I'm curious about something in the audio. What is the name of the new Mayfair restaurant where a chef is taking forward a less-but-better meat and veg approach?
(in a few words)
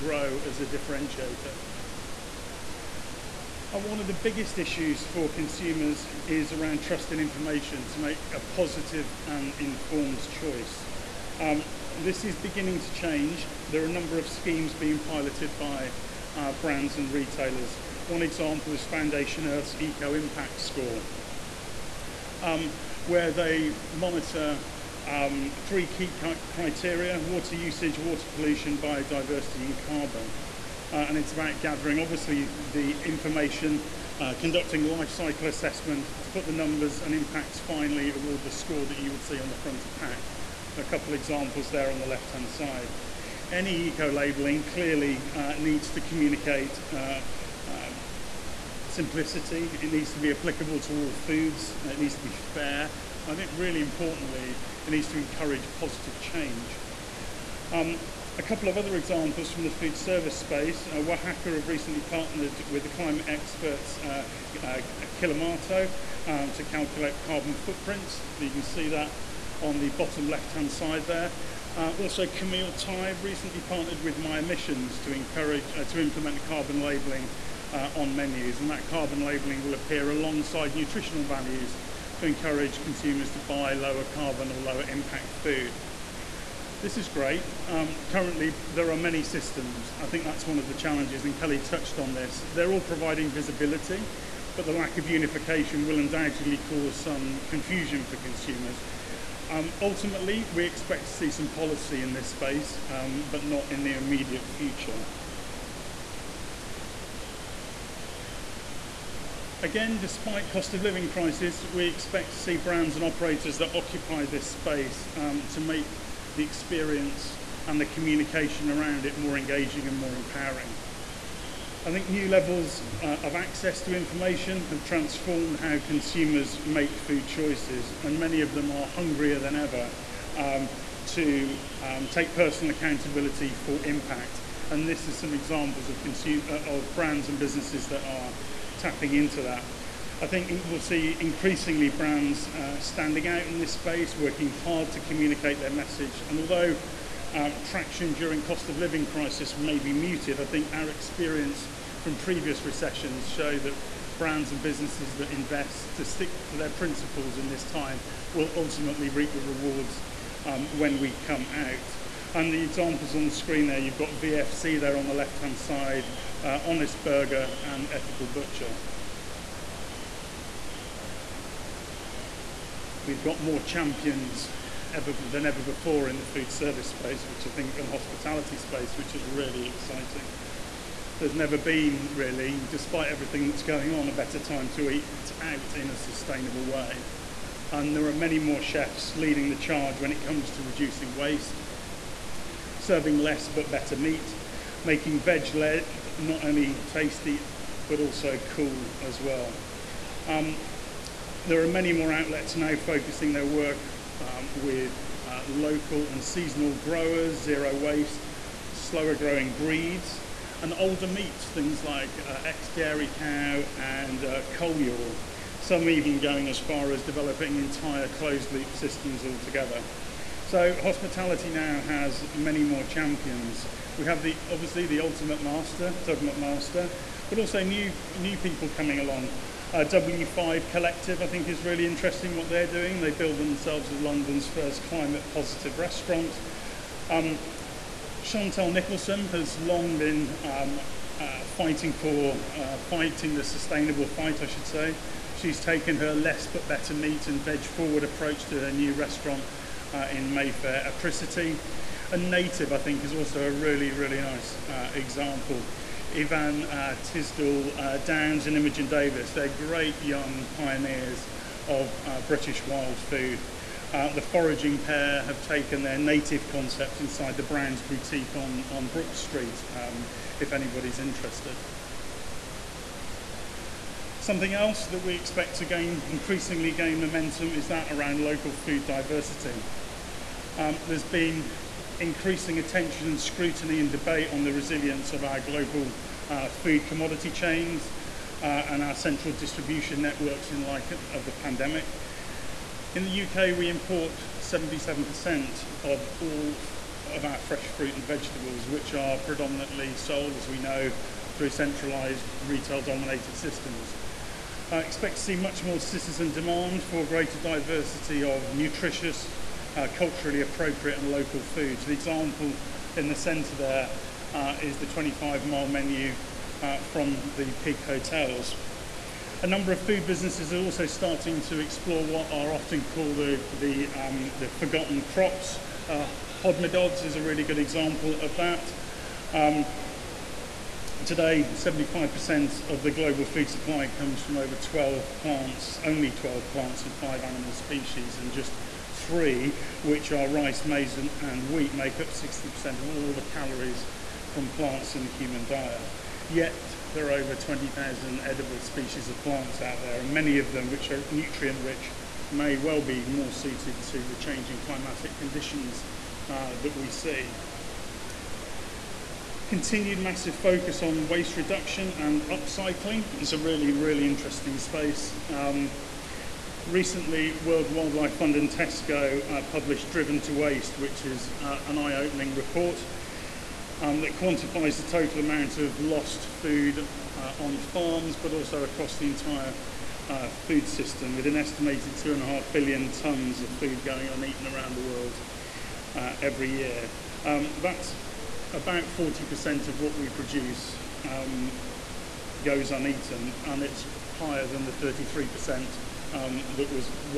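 Apricity.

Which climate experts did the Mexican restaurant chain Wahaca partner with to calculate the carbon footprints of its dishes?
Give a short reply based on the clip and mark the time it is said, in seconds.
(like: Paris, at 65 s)
Klimato, at 65 s.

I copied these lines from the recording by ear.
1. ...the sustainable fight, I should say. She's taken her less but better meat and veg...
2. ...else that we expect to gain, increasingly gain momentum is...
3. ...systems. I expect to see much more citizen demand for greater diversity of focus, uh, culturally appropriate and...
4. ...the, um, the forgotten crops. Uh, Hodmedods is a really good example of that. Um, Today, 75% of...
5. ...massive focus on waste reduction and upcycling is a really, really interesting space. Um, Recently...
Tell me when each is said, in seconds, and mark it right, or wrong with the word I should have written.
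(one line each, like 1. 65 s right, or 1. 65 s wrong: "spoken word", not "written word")
1. 243 s right
2. 274 s right
3. 303 s wrong: "nutritious", not "focus"
4. 323 s right
5. 359 s right.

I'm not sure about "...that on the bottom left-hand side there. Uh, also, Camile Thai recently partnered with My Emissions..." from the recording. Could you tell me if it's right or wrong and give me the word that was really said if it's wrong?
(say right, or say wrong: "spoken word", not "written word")
right.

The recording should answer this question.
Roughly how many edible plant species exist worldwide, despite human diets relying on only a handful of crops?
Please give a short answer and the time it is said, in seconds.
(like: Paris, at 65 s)
over 20,000, at 347 s.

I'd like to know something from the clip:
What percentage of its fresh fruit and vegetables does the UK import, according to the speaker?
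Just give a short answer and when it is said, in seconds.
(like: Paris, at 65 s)
77%, at 294 s.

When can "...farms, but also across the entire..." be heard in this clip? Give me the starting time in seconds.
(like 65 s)
377 s.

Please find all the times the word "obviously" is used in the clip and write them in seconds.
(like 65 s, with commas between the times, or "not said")
31 s, 224 s.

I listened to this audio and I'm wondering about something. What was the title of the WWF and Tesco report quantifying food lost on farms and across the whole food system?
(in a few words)
Driven to Waste.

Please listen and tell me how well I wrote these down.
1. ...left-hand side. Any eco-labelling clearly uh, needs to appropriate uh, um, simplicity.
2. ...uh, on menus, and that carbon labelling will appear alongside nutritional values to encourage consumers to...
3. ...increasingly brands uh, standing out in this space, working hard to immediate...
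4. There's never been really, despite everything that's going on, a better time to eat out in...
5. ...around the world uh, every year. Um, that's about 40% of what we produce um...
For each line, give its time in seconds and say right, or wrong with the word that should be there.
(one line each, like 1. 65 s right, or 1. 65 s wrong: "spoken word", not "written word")
1. 42 s wrong: "communicate", not "appropriate"
2. 77 s right
3. 141 s wrong: "communicate", not "immediate"
4. 181 s right
5. 384 s right.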